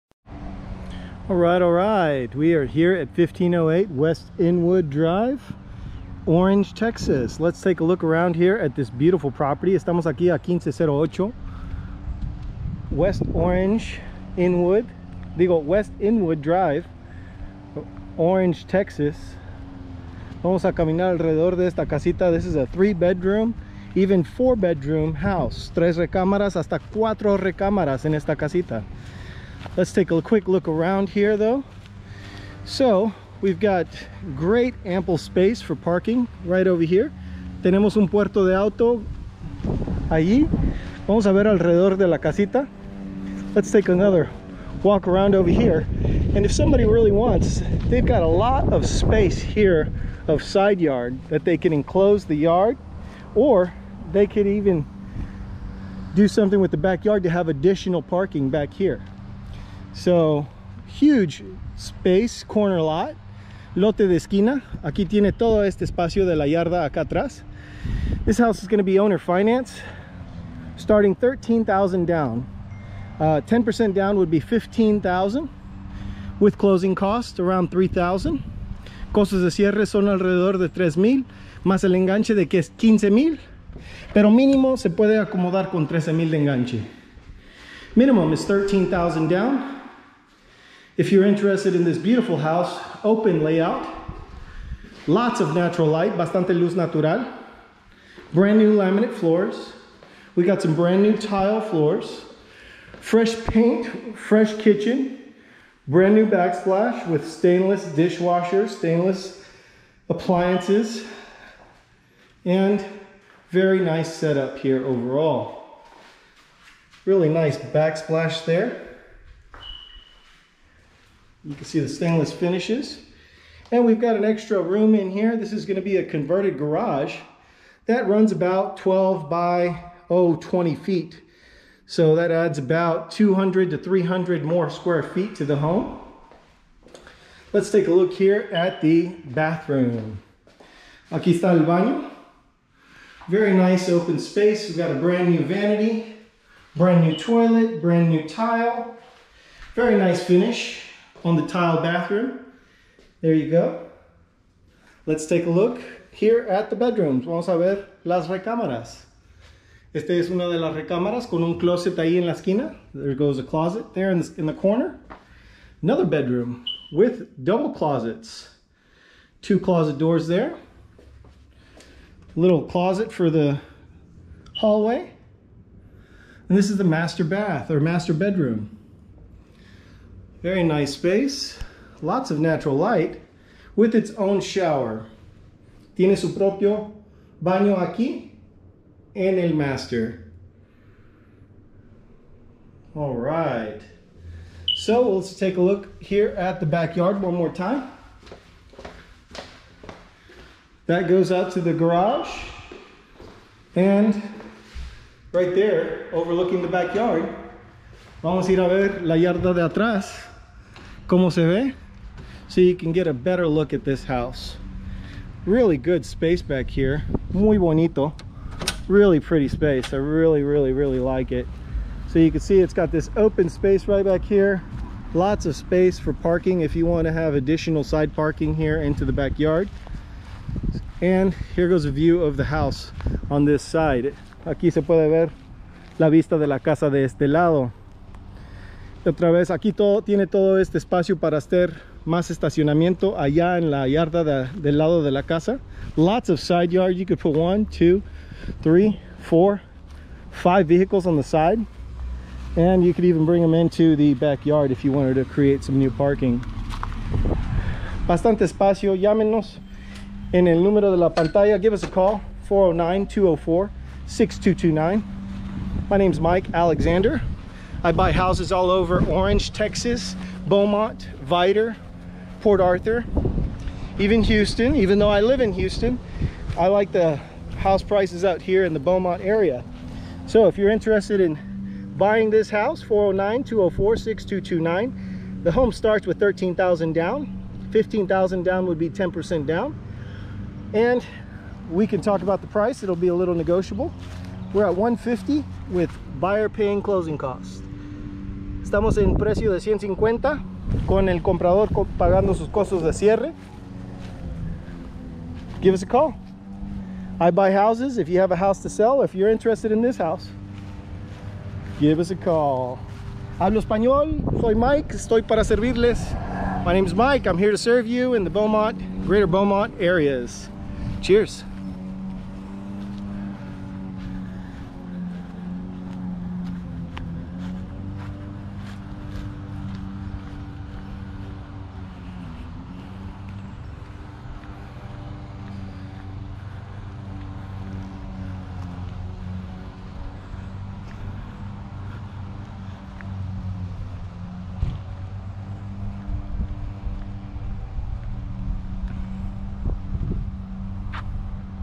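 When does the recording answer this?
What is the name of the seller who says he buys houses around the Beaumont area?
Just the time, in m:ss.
4:26.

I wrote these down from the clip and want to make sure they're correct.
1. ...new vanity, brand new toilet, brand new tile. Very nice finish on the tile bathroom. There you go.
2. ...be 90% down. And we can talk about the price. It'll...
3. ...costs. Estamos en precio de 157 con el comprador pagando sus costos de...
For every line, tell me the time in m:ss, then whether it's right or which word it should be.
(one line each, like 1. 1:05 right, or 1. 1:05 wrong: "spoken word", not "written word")
1. 2:25 right
2. 4:48 wrong: "10", not "90"
3. 4:57 wrong: "150", not "157".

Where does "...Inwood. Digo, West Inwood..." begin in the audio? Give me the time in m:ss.
0:14.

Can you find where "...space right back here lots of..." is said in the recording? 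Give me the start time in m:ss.
3:43.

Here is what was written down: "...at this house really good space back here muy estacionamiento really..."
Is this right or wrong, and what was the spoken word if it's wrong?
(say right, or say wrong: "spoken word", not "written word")
wrong: "bonito", not "estacionamiento".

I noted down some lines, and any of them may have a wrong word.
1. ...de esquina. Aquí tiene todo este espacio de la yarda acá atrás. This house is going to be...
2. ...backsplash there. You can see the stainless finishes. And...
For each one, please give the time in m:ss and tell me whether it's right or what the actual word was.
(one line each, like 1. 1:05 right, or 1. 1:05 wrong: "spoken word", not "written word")
1. 1:04 right
2. 1:57 right.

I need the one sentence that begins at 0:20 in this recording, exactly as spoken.
Vamos a caminar alrededor de esta casita.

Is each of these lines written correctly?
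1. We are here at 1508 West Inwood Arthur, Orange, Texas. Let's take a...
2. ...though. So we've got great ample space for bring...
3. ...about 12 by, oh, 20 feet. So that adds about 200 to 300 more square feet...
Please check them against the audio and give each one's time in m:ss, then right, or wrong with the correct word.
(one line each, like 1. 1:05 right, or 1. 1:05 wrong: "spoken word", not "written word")
1. 0:02 wrong: "Drive", not "Arthur"
2. 0:31 wrong: "parking", not "bring"
3. 2:08 right.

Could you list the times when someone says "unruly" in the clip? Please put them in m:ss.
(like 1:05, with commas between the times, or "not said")
not said.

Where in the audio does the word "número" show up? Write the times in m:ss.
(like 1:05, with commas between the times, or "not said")
4:20.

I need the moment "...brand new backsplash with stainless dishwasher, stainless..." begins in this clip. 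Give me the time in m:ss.
1:45.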